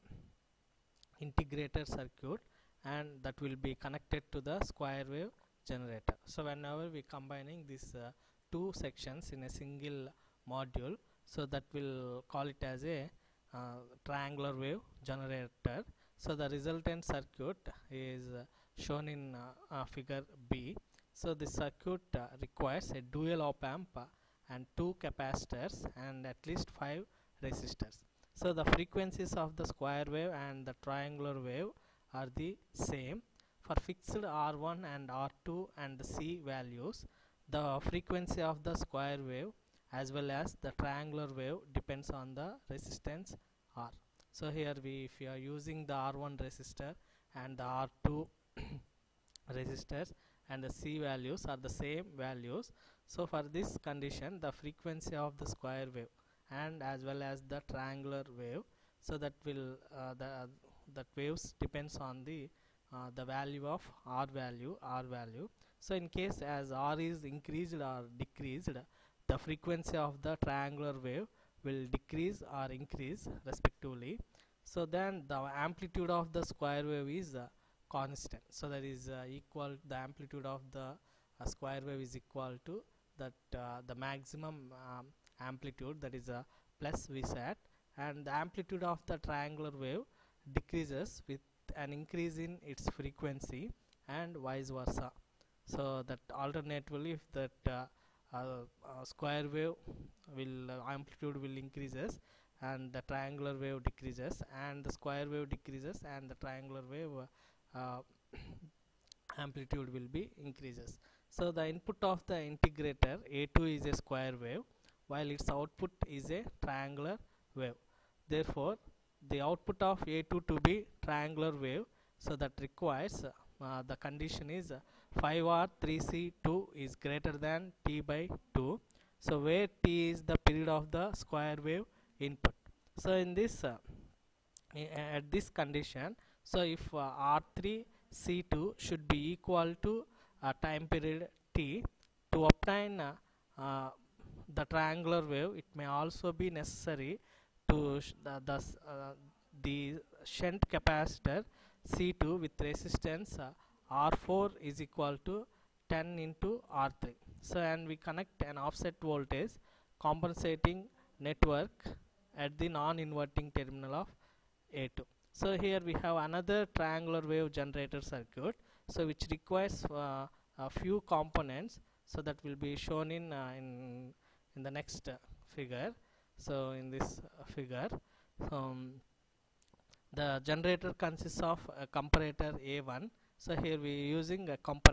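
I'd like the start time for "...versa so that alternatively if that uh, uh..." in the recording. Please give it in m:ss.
1:34.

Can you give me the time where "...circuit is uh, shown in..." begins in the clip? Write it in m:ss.
0:17.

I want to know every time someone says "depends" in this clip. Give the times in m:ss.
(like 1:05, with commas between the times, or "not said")
0:41, 1:01.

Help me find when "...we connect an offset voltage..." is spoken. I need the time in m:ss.
2:37.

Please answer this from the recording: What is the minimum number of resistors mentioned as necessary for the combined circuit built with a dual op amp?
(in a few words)
5.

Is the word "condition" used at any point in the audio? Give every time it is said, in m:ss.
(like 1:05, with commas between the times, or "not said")
0:53, 2:03, 2:15.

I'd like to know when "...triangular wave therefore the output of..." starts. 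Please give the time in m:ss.
1:56.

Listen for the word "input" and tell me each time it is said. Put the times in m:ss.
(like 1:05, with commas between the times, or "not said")
1:51, 2:12.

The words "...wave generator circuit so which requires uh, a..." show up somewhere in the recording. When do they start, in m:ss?
2:47.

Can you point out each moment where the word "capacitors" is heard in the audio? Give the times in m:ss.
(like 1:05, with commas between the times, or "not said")
0:25, 2:30.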